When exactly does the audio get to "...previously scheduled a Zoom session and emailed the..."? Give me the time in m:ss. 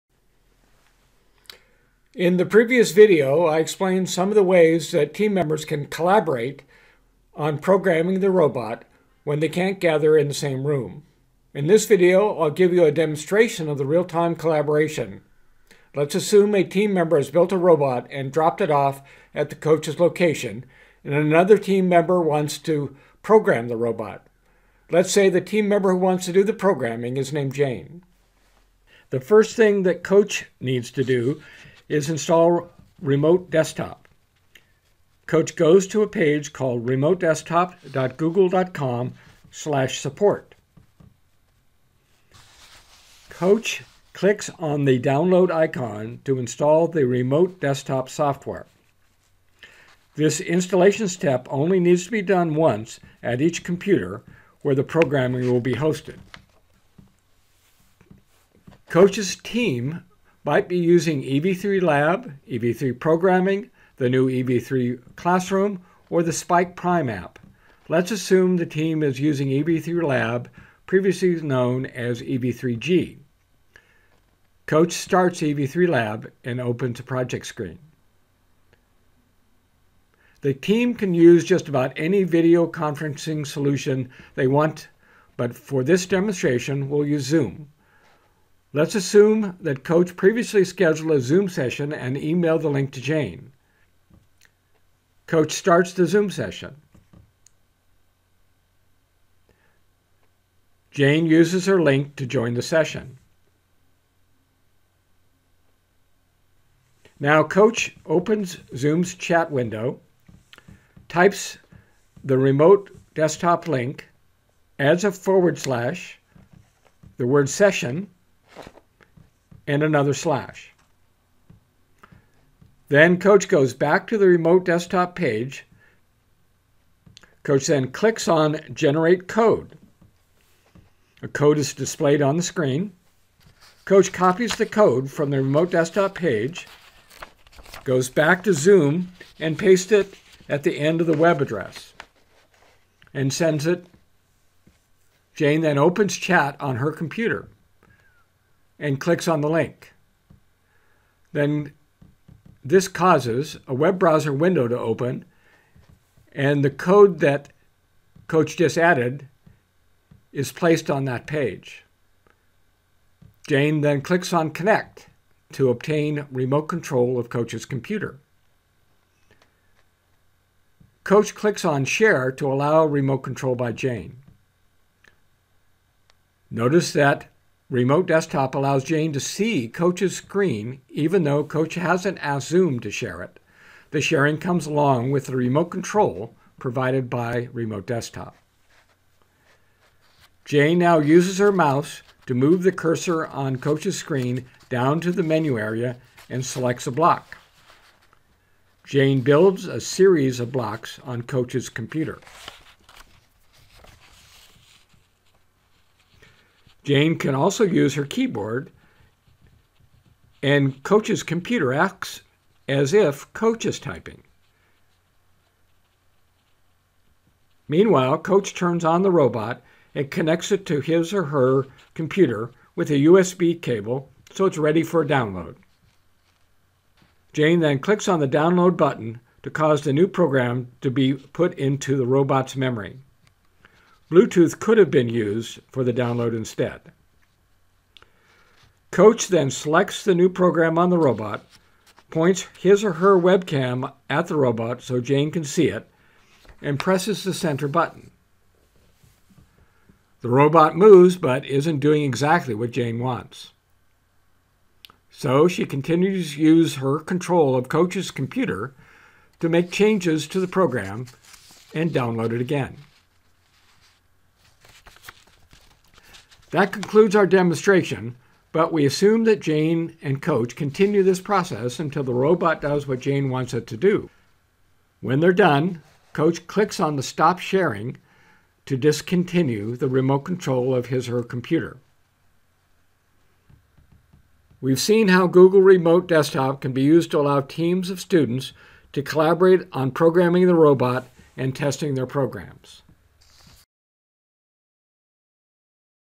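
1:30.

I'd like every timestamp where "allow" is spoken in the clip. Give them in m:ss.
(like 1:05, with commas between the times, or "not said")
2:52, 2:58, 4:47.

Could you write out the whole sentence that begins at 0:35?
Coach goes to a page called remotedesktop.google.com slash support.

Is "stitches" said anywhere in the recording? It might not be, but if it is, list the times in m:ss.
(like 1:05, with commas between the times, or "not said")
not said.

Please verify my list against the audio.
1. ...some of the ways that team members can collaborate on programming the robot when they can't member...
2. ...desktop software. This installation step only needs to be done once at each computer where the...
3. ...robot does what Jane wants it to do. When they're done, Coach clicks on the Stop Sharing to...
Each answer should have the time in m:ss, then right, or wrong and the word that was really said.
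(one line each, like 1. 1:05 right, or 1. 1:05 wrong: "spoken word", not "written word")
1. 0:04 wrong: "gather", not "member"
2. 0:47 right
3. 4:32 right.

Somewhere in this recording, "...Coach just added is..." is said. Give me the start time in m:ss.
2:38.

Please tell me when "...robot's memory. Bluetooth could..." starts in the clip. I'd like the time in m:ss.
3:52.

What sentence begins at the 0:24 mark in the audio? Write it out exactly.
Let's say the team member who wants to do the programming is named Jane.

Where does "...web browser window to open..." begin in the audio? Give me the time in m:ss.
2:33.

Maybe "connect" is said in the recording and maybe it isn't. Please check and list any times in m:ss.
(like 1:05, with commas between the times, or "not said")
2:44, 3:40.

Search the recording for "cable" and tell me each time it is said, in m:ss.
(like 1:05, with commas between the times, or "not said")
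3:43.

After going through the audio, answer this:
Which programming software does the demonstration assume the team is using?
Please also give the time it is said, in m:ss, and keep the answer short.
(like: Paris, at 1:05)
EV3 Lab, at 1:07.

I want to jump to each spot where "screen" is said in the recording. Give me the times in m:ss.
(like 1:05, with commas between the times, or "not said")
1:17, 2:12, 3:00, 3:13.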